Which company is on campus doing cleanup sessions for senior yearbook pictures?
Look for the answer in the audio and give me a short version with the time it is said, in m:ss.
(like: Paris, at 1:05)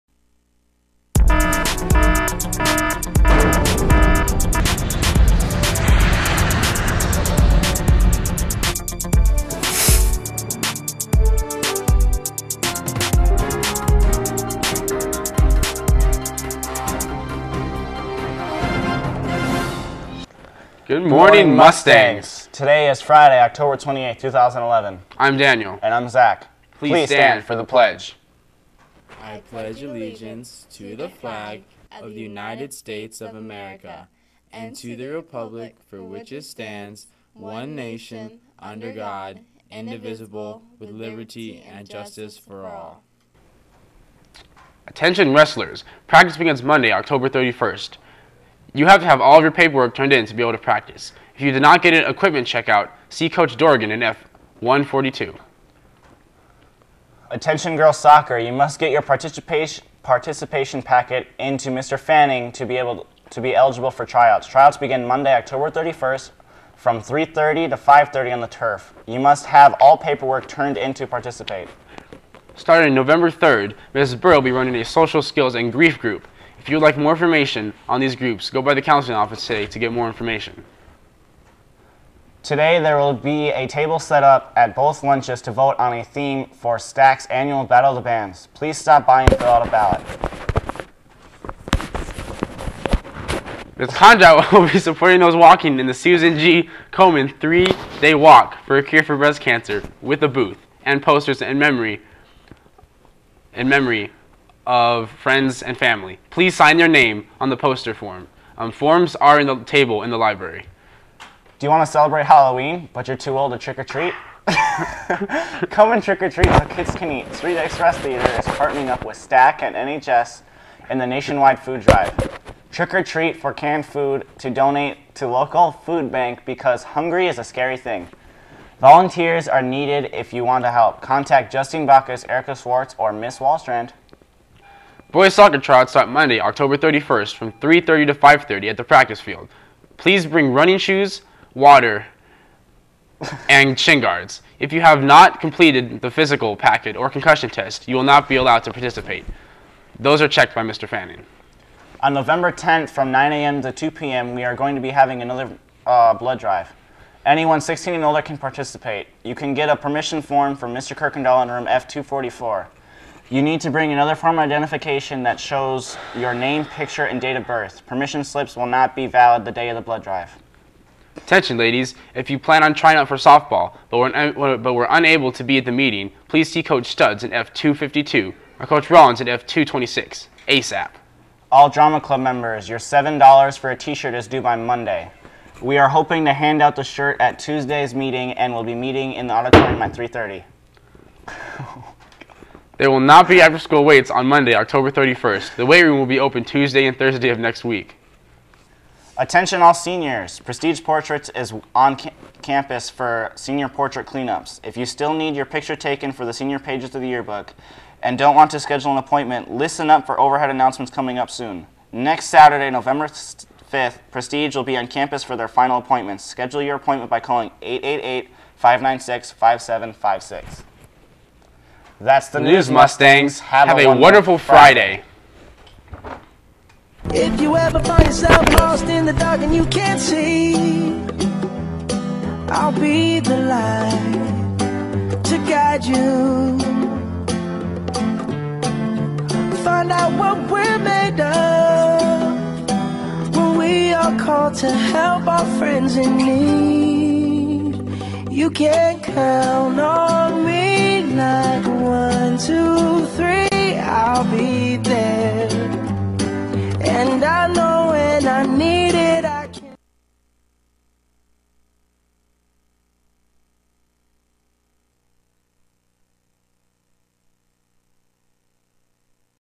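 Prestige Portraits, at 3:20.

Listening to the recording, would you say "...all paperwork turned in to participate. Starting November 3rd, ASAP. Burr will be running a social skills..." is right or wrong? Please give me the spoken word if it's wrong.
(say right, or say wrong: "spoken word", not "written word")
wrong: "Mrs", not "ASAP".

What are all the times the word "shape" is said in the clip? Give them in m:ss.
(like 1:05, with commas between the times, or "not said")
not said.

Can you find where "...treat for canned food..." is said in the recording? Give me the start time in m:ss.
2:03.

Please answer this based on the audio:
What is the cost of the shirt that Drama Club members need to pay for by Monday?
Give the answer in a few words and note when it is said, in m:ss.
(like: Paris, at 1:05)
$7, at 3:02.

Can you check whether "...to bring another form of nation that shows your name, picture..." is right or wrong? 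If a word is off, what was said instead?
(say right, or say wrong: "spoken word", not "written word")
wrong: "identification", not "nation".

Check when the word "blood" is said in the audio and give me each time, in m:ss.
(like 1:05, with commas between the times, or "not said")
2:36, 2:49.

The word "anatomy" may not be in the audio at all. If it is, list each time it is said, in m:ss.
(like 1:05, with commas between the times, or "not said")
not said.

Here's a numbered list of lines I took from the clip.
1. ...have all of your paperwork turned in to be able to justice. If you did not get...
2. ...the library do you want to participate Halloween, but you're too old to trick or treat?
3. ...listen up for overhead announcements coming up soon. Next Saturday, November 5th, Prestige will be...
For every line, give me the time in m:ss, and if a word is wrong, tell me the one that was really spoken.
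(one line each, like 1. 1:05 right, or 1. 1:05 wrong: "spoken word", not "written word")
1. 0:49 wrong: "practice", not "justice"
2. 1:50 wrong: "celebrate", not "participate"
3. 3:29 right.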